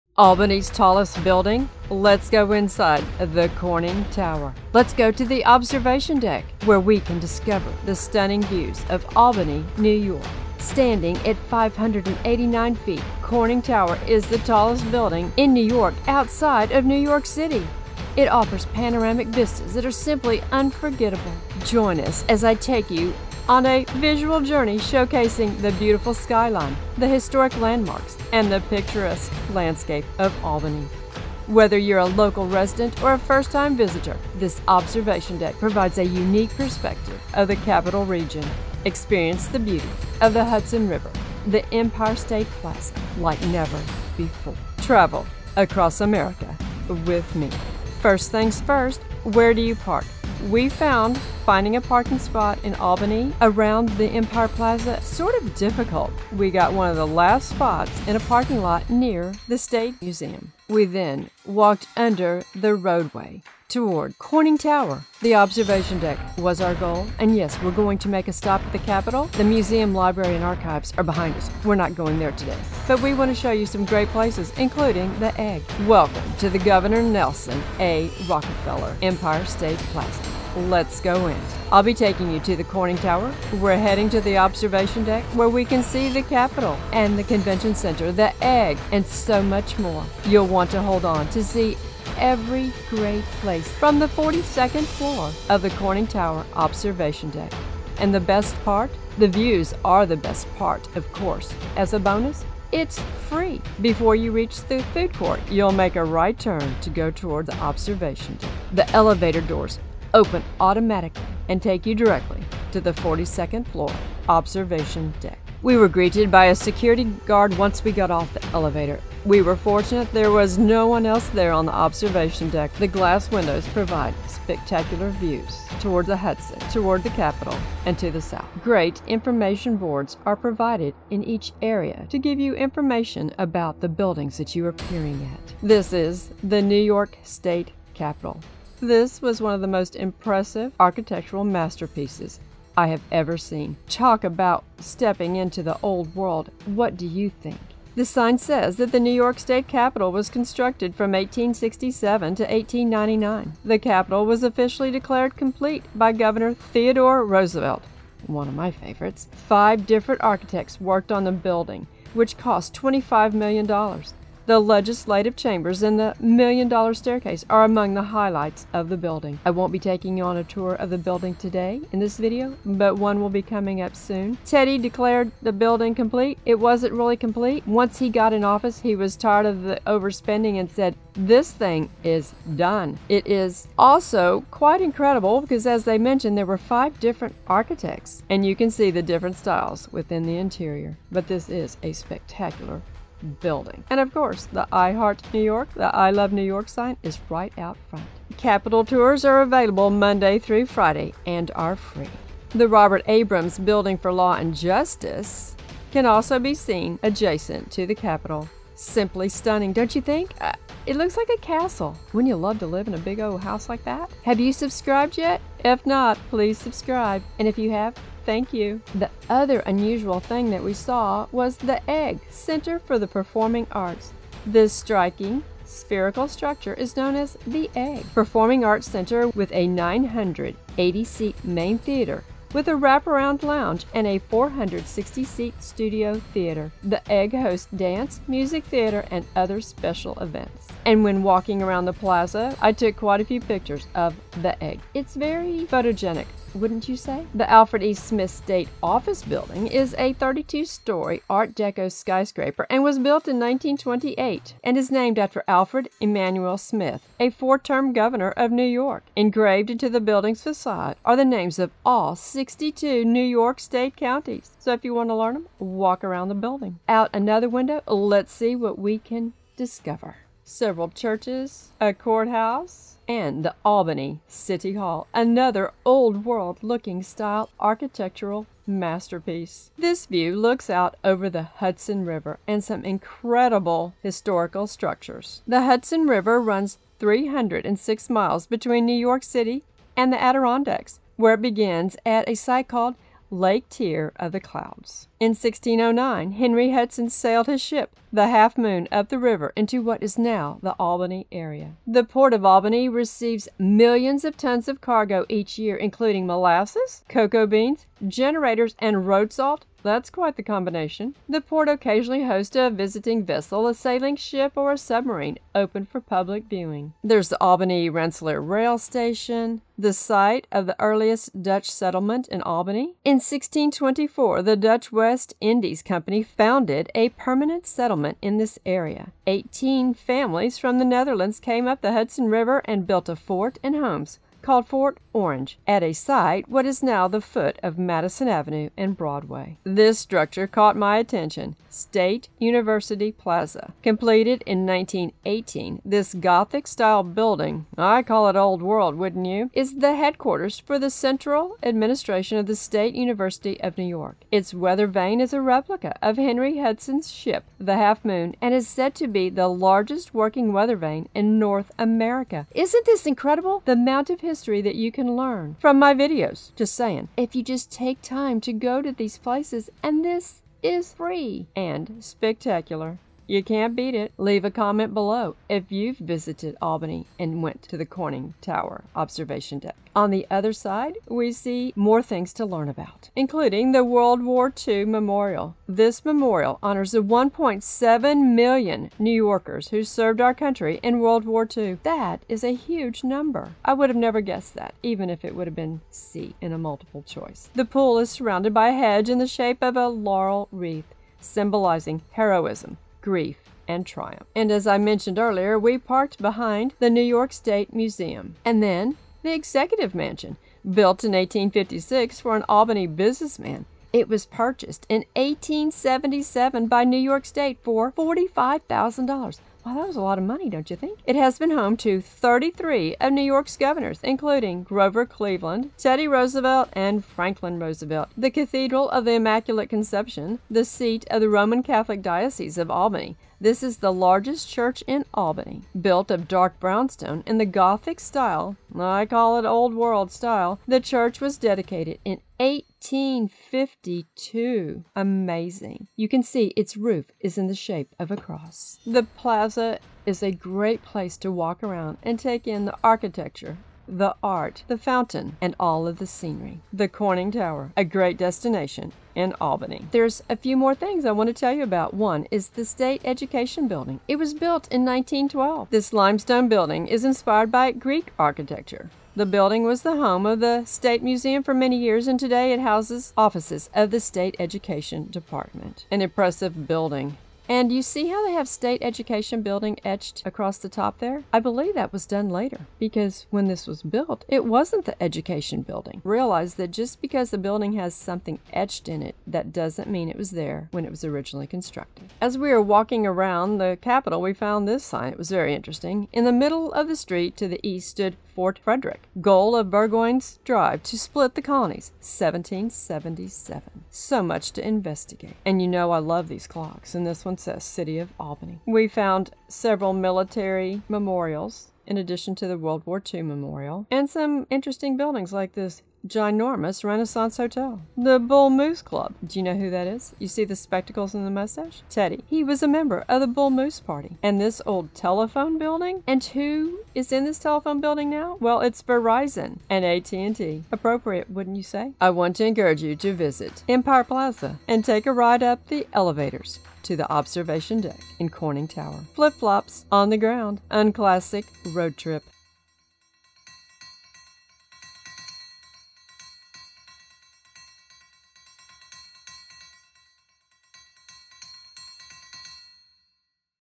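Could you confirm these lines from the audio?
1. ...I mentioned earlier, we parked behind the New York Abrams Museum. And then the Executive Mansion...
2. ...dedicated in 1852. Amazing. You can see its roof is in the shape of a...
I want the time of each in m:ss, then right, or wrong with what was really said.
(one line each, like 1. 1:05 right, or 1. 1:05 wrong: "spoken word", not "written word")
1. 6:44 wrong: "State", not "Abrams"
2. 7:21 right.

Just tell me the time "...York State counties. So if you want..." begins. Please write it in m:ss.
4:23.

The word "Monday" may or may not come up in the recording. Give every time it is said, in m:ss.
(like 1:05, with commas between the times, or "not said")
3:19.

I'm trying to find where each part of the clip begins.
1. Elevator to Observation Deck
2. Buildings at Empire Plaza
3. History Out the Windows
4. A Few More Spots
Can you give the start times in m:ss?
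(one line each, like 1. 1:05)
1. 1:47
2. 2:17
3. 4:28
4. 7:32.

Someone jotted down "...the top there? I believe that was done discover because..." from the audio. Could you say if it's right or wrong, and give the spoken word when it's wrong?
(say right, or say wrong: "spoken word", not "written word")
wrong: "later", not "discover".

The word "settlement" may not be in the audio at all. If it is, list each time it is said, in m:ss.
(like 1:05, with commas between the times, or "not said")
5:21, 5:27.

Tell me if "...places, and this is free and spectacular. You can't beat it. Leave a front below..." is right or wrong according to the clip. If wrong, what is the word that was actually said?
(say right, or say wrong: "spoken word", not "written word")
wrong: "comment", not "front".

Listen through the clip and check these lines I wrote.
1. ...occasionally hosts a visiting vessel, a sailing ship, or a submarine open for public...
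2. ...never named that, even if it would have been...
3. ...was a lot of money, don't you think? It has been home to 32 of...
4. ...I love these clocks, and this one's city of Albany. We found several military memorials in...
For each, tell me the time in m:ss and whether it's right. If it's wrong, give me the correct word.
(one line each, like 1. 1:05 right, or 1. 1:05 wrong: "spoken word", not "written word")
1. 5:11 right
2. 6:33 wrong: "guessed", not "named"
3. 6:59 wrong: "33", not "32"
4. 8:25 right.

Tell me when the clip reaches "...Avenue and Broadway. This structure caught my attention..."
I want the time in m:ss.
5:38.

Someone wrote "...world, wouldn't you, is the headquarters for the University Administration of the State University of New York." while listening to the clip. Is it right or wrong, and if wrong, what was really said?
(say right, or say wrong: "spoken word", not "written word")
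wrong: "Central", not "University".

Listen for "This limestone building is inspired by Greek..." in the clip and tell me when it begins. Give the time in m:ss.
7:45.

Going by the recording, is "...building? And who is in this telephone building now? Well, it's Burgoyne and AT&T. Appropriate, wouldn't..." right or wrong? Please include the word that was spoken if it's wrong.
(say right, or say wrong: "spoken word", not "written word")
wrong: "Verizon", not "Burgoyne".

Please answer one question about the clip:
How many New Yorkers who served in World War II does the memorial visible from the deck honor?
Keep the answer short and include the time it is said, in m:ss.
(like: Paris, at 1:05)
1.7 million, at 6:27.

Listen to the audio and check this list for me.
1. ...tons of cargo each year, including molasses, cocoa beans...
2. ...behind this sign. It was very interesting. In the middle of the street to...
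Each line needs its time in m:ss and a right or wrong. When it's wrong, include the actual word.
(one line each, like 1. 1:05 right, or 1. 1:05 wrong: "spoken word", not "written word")
1. 5:04 right
2. 8:14 wrong: "found", not "behind".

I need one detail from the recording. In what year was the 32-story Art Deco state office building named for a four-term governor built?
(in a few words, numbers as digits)
1928.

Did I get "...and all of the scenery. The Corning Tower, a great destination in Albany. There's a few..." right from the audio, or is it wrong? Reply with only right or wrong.
right.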